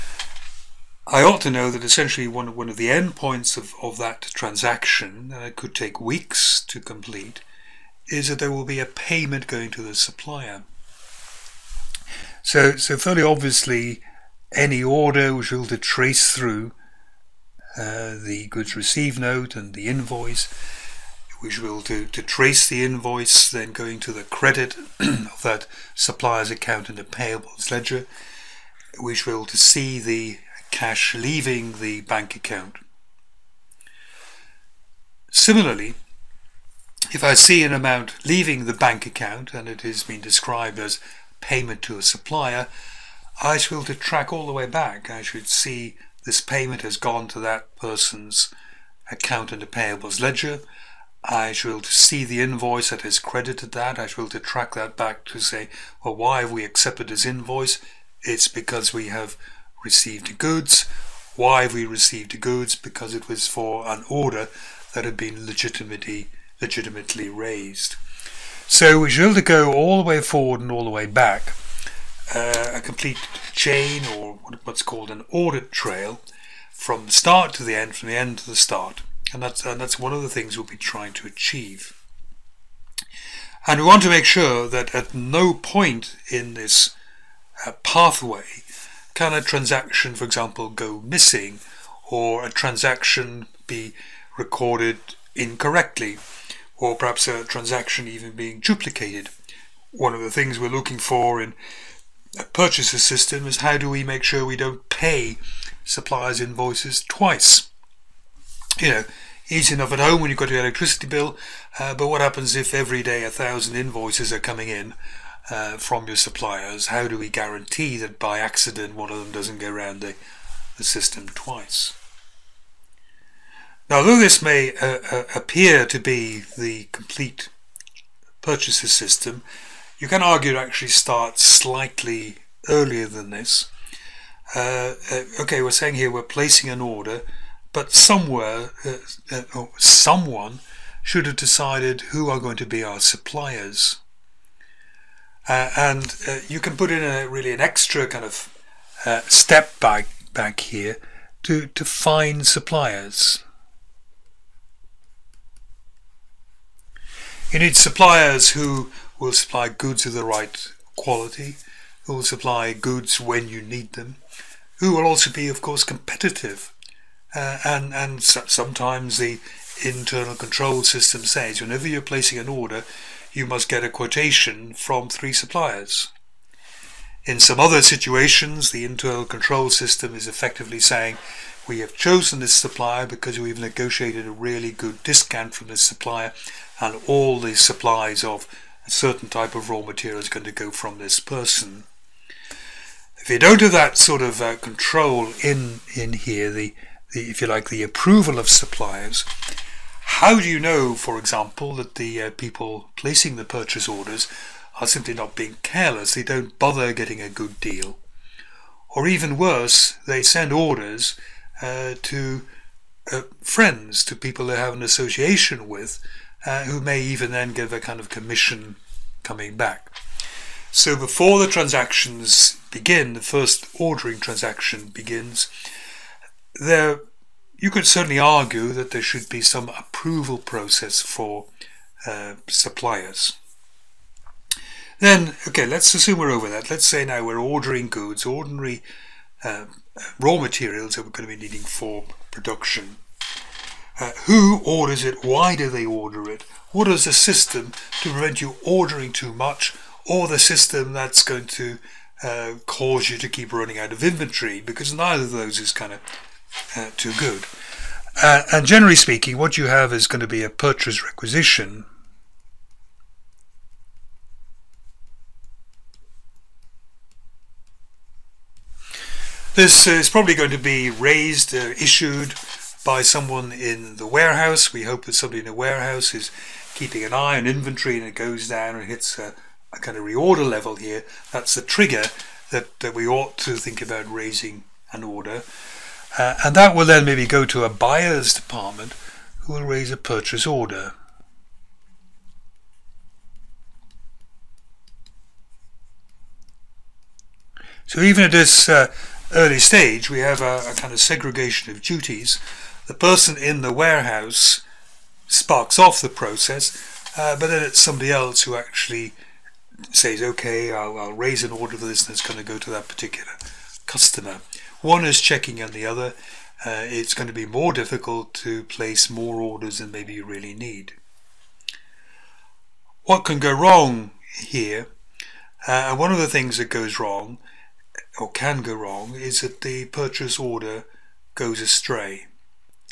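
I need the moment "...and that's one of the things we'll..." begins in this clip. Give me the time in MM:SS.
01:19.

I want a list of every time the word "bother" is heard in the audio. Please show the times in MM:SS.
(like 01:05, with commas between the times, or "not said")
03:26.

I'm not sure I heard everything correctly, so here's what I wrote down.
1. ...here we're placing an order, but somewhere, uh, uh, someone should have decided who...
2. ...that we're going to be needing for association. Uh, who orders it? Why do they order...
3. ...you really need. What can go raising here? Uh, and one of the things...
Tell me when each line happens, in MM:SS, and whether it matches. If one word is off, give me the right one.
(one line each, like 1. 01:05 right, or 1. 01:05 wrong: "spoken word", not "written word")
1. 02:15 right
2. 04:00 wrong: "production", not "association"
3. 05:20 wrong: "wrong", not "raising".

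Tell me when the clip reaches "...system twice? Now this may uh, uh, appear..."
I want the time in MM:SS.
02:00.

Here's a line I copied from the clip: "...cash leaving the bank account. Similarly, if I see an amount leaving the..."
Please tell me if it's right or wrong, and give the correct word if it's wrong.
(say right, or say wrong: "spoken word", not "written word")
right.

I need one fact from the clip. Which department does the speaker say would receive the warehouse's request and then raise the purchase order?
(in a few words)
buyer's department.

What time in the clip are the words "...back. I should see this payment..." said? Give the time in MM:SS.
00:44.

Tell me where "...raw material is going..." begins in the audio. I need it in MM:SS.
03:09.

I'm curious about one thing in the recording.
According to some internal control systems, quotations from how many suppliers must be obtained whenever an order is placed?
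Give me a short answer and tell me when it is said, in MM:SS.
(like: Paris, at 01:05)
3, at 02:55.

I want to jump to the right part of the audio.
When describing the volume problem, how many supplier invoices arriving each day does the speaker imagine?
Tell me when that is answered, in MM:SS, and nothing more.
01:53.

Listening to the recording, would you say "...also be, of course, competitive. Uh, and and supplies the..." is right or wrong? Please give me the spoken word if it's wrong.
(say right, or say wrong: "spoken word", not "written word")
wrong: "sometimes", not "supplies".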